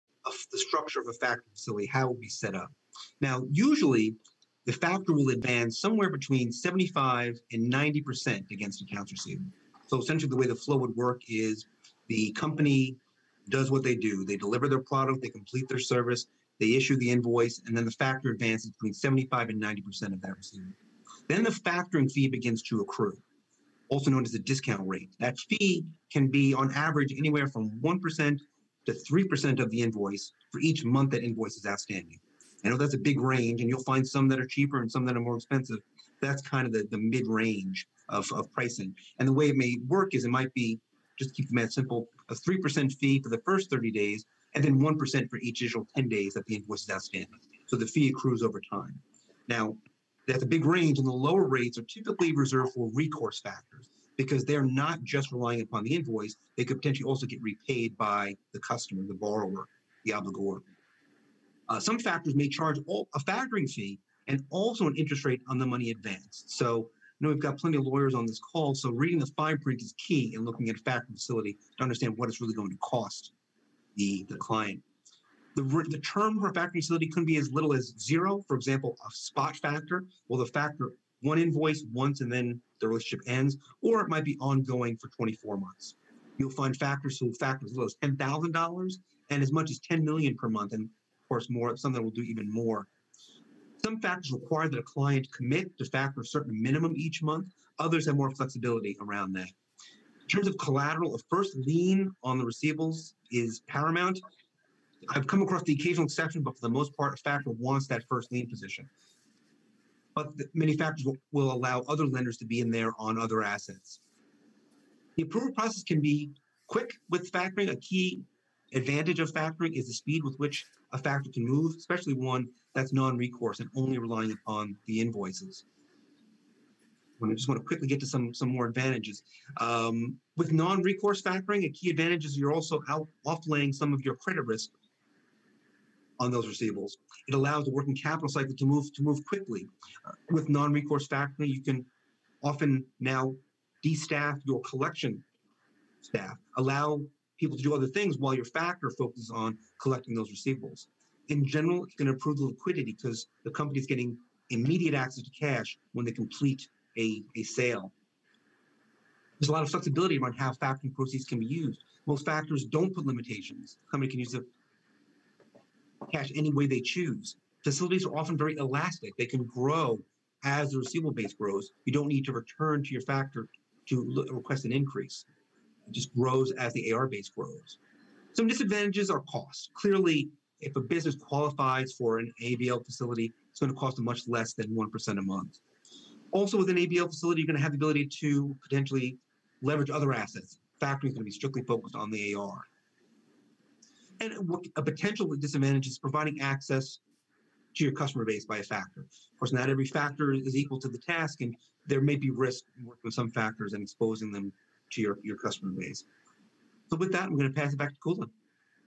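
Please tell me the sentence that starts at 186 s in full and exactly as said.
Also, with an ABL facility, you're going to have the ability to potentially leverage other assets.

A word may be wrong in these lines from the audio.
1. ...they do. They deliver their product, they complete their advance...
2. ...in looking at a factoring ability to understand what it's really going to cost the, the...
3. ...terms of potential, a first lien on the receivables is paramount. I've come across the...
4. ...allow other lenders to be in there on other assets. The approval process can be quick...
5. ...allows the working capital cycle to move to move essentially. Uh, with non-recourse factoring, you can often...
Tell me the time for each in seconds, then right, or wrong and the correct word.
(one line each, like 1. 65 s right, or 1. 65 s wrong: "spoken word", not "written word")
1. 13 s wrong: "service", not "advance"
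2. 70 s wrong: "facility", not "ability"
3. 100 s wrong: "collateral", not "potential"
4. 111 s right
5. 137 s wrong: "quickly", not "essentially".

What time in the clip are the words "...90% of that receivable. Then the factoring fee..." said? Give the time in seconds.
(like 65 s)
19 s.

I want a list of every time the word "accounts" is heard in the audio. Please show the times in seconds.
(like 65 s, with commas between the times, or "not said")
8 s.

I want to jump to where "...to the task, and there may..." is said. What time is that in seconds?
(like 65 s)
200 s.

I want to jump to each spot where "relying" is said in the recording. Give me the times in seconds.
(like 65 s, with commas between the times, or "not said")
55 s, 123 s.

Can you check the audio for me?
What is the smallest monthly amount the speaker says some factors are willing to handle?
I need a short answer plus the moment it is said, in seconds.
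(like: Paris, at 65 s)
$10,000, at 88 s.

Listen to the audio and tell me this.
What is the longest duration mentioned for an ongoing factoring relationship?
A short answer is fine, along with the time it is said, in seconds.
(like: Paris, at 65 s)
24 months, at 85 s.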